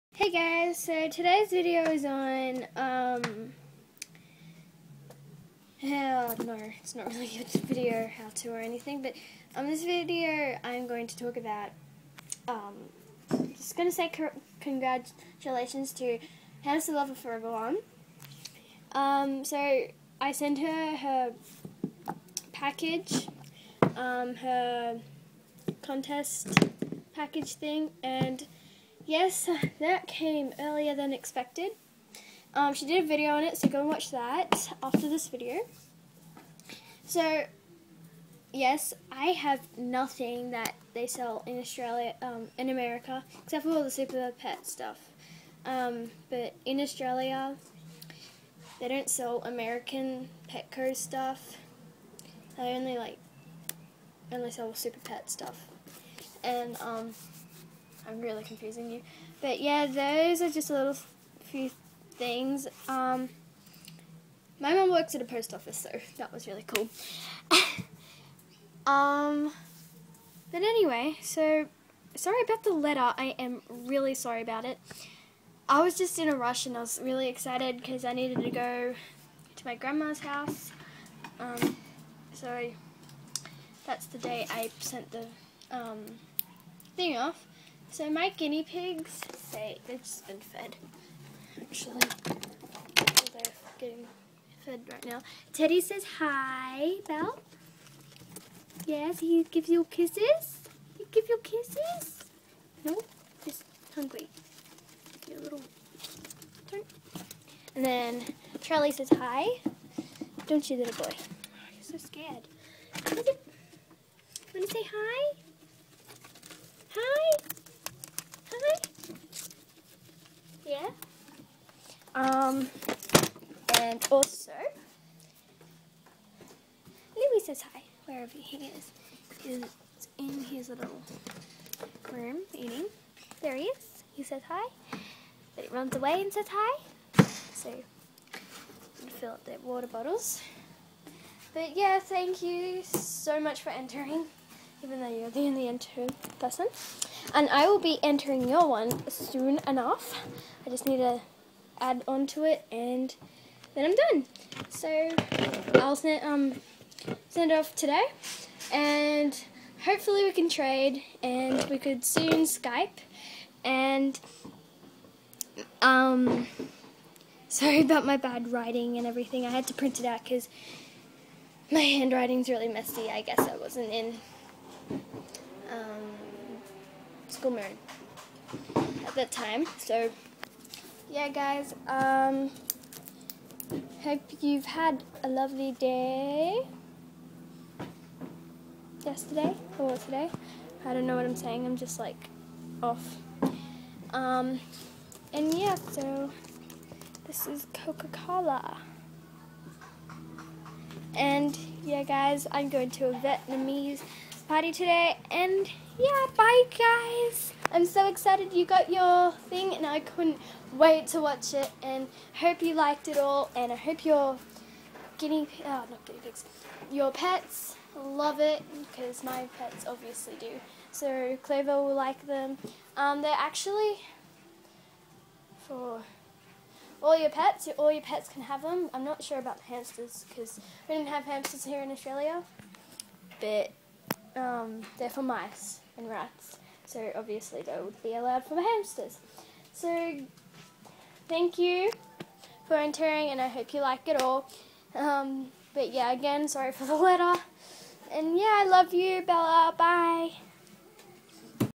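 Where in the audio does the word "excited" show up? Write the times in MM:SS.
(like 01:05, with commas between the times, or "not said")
01:17, 03:28.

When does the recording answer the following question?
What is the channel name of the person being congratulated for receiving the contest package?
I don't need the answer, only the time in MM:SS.
00:16.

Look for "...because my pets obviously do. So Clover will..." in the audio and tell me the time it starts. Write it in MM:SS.
03:38.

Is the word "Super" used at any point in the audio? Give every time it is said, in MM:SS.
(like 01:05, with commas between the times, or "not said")
00:43, 00:54.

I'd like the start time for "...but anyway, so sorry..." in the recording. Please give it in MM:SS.
01:10.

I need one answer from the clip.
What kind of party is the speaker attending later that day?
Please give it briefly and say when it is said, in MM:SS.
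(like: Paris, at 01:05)
Vietnamese party, at 03:23.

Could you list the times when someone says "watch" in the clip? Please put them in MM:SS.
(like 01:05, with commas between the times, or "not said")
00:33, 03:31.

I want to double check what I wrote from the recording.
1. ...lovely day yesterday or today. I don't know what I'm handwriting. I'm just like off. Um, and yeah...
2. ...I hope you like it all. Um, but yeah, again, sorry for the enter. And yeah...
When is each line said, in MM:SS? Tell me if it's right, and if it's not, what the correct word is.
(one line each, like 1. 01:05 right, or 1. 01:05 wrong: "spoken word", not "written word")
1. 03:05 wrong: "saying", not "handwriting"
2. 04:03 wrong: "letter", not "enter".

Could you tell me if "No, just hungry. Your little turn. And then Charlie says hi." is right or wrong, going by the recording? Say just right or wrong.
right.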